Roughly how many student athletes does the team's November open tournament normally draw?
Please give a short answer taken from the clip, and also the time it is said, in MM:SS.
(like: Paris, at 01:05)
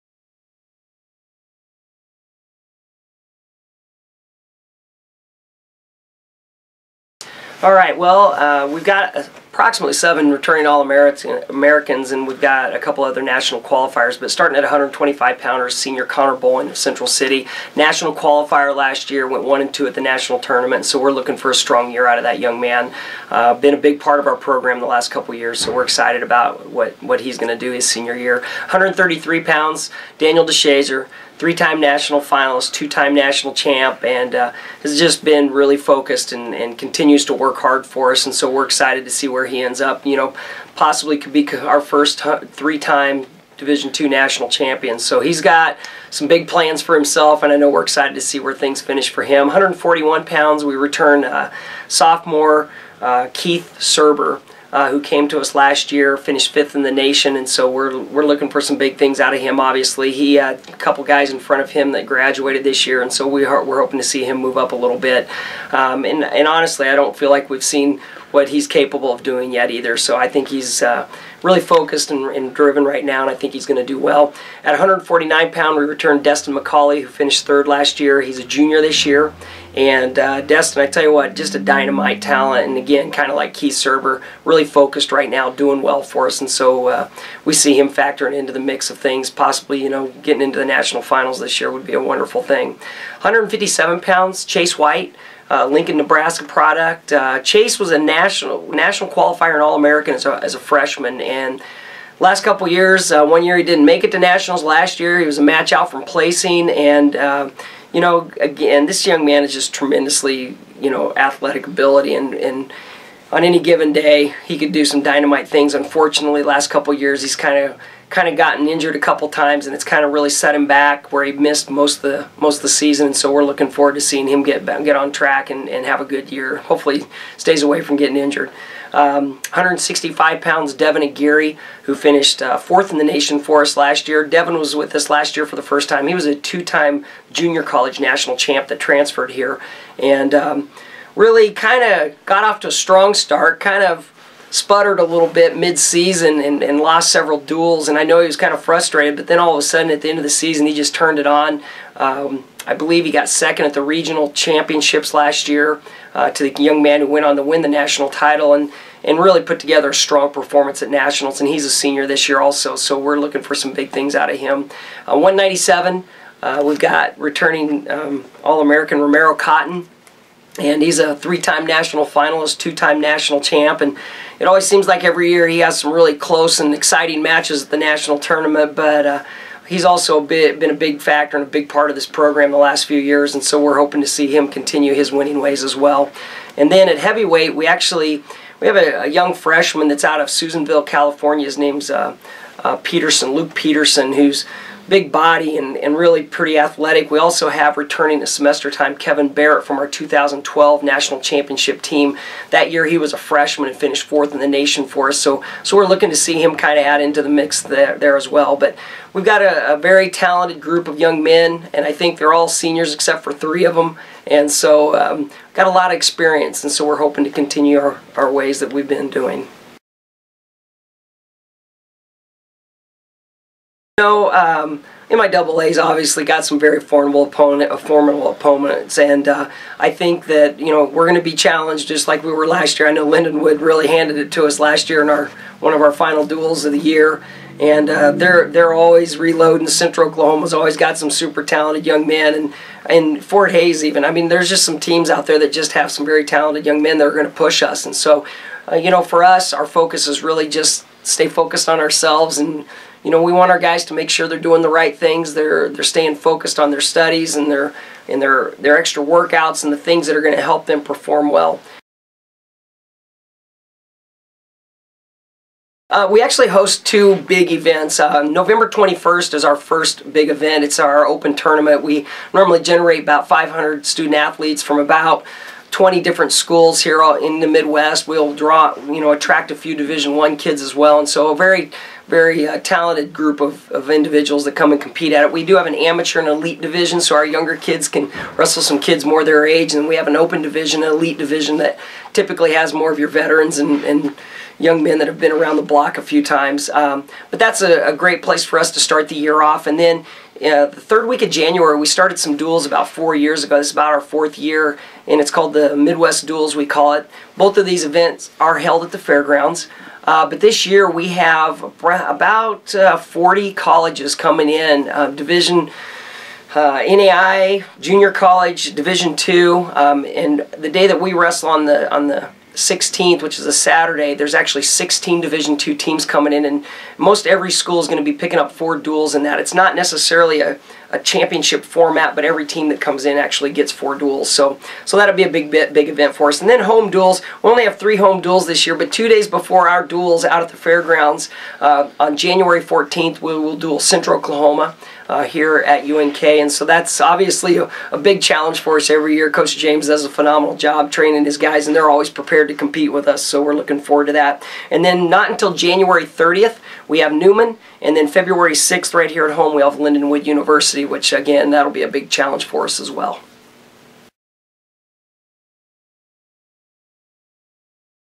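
500, at 04:33.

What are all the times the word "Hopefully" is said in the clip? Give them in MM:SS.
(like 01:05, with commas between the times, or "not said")
02:06.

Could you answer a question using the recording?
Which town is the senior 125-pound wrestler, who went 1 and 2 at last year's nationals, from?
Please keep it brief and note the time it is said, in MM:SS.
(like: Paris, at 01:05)
Central City, at 00:16.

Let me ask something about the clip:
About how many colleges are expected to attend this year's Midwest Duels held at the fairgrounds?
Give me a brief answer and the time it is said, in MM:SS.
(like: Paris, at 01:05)
40, at 05:12.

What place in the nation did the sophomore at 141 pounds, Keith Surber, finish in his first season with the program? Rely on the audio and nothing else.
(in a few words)
5th.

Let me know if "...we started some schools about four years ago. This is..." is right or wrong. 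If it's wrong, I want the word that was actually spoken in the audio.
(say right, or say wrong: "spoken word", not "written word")
wrong: "duels", not "schools".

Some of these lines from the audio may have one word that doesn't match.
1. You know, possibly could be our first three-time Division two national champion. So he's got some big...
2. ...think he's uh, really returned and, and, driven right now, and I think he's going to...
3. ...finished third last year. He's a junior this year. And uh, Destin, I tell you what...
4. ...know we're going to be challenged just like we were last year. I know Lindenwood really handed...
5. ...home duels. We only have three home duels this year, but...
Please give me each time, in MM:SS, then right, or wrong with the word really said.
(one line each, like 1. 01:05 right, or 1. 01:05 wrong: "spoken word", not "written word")
1. 00:40 right
2. 01:10 wrong: "focused", not "returned"
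3. 01:17 right
4. 03:50 right
5. 05:36 right.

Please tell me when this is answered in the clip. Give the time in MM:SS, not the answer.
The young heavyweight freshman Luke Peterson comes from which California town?
03:10.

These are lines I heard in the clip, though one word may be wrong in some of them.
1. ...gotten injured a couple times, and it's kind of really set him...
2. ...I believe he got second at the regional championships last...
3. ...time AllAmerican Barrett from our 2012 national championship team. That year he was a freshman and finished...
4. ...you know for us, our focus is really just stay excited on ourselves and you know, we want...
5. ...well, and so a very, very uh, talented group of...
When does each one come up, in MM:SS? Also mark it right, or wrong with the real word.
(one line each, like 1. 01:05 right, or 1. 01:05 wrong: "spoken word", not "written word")
1. 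01:58 right
2. 02:32 right
3. 03:18 wrong: "Kevin", not "AllAmerican"
4. 04:08 wrong: "focused", not "excited"
5. 04:40 right.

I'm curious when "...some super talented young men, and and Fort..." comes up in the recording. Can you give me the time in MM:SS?
04:00.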